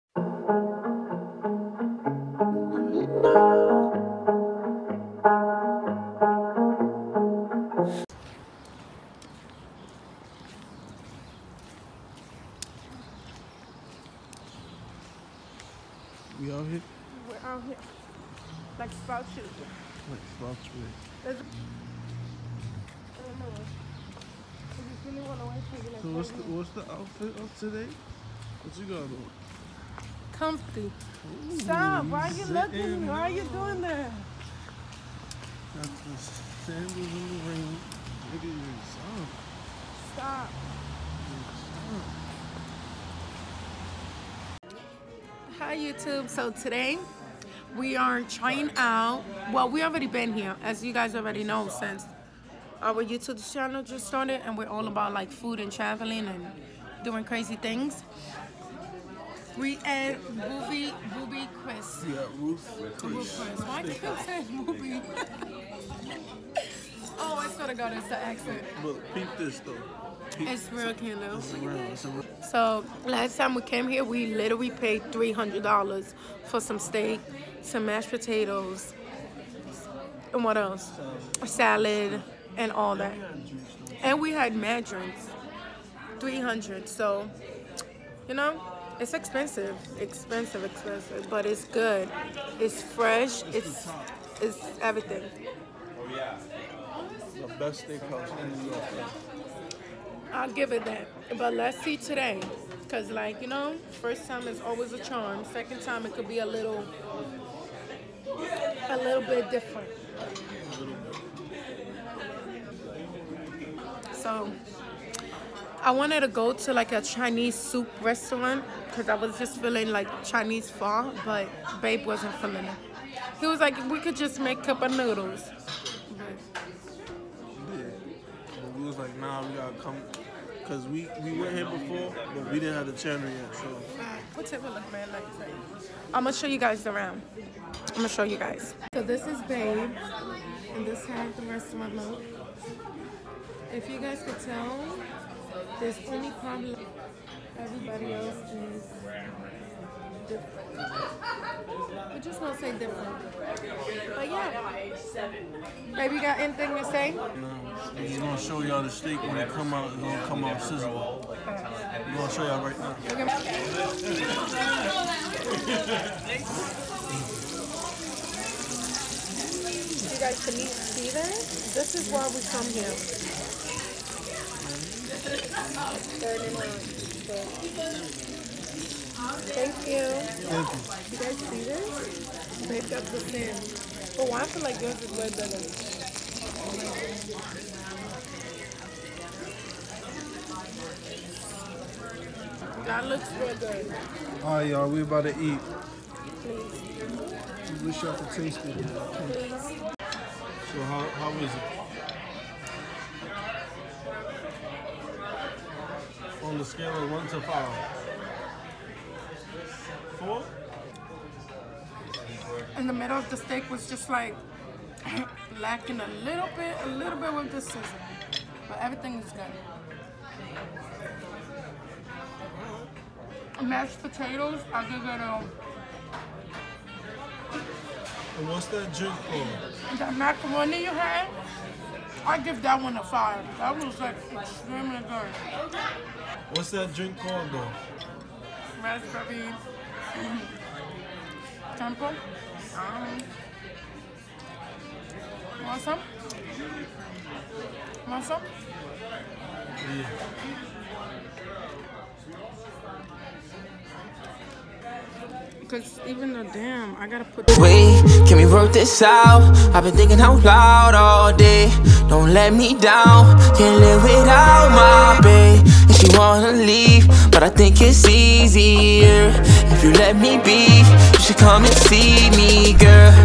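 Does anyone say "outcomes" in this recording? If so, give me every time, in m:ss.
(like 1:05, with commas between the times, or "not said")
not said.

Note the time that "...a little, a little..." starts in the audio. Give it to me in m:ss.
1:46.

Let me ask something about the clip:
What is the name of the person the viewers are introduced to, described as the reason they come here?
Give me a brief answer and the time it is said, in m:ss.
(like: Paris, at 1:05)
Steven, at 2:50.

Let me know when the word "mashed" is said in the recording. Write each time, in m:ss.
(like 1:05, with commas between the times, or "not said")
1:17, 3:43.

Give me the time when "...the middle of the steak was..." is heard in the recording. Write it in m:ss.
3:32.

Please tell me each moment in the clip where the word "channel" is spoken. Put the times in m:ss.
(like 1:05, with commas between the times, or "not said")
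0:53, 2:12.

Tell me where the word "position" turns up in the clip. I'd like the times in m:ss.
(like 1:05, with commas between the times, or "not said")
not said.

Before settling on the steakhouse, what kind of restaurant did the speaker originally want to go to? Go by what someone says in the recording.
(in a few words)
Chinese soup restaurant.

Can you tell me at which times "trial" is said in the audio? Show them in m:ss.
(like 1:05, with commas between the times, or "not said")
not said.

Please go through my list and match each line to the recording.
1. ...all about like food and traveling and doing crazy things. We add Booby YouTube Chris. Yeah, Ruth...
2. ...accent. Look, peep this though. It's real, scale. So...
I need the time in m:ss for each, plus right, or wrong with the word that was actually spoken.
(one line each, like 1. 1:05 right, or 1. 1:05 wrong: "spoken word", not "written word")
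1. 0:54 wrong: "Booby", not "YouTube"
2. 1:08 wrong: "candle", not "scale".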